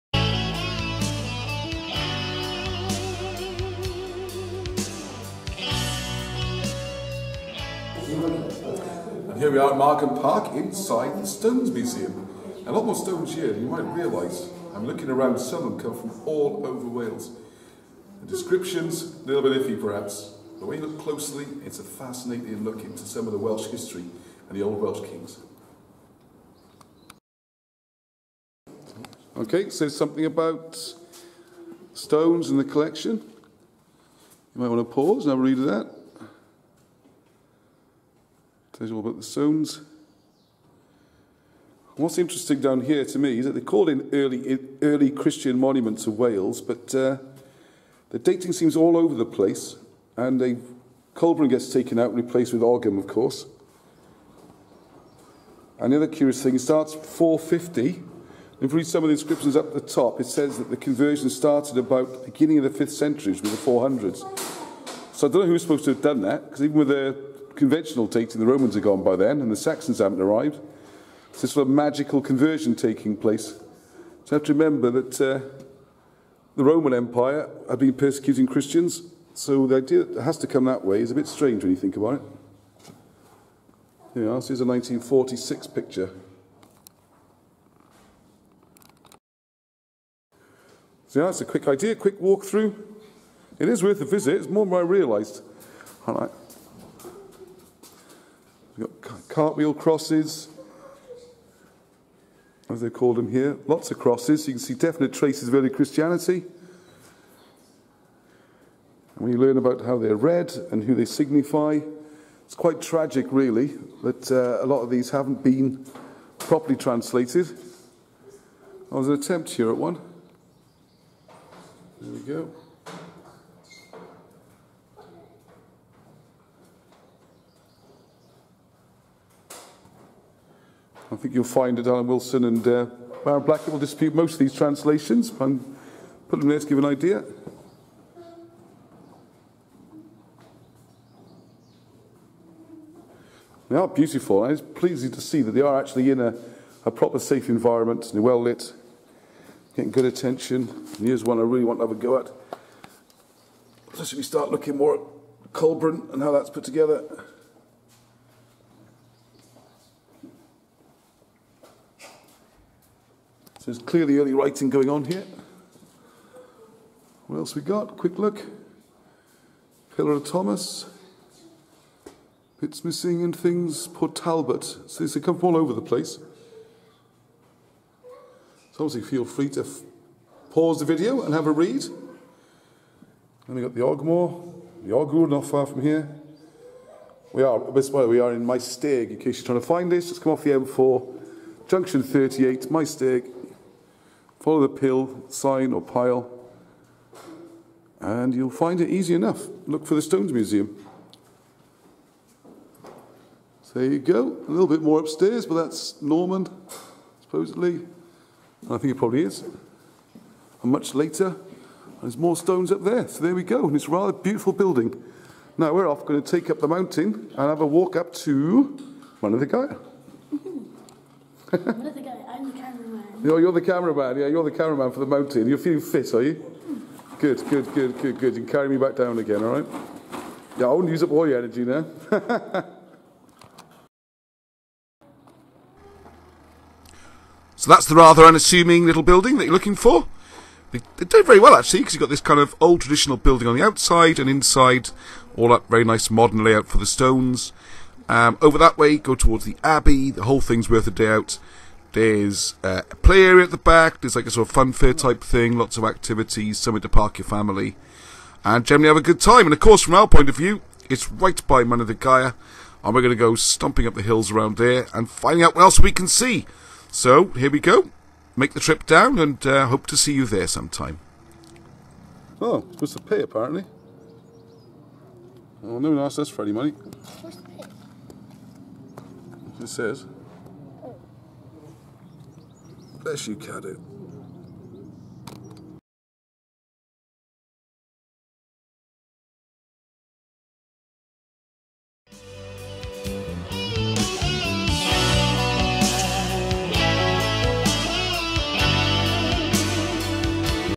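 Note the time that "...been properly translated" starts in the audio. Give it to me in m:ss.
1:55.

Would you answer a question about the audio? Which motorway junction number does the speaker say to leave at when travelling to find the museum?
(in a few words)
38.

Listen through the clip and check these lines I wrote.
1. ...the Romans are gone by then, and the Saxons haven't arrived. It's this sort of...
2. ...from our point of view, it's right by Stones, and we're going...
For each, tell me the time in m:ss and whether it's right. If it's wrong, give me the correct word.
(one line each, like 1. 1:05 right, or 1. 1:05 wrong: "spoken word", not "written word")
1. 1:08 right
2. 4:19 wrong: "Manadagaya", not "Stones".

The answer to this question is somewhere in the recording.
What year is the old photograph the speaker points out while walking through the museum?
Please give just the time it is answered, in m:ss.
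1:24.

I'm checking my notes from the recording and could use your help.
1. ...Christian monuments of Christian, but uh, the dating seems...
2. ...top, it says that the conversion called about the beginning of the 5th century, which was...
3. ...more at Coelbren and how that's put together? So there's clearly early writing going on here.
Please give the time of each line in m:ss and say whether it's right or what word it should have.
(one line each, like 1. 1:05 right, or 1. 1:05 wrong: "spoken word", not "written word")
1. 0:45 wrong: "Wales", not "Christian"
2. 0:59 wrong: "started", not "called"
3. 2:34 right.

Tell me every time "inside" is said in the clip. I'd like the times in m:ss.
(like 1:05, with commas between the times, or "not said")
0:10, 4:04.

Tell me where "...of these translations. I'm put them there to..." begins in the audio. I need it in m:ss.
2:14.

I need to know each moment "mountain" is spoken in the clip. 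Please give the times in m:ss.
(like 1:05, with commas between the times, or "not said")
3:36, 3:45.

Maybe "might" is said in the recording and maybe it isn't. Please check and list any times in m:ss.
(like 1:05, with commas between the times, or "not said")
0:13, 0:34.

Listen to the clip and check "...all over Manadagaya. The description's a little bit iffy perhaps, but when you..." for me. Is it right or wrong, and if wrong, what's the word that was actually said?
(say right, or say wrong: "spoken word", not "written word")
wrong: "Wales", not "Manadagaya".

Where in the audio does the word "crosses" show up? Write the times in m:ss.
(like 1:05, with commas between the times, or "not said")
1:39, 1:43.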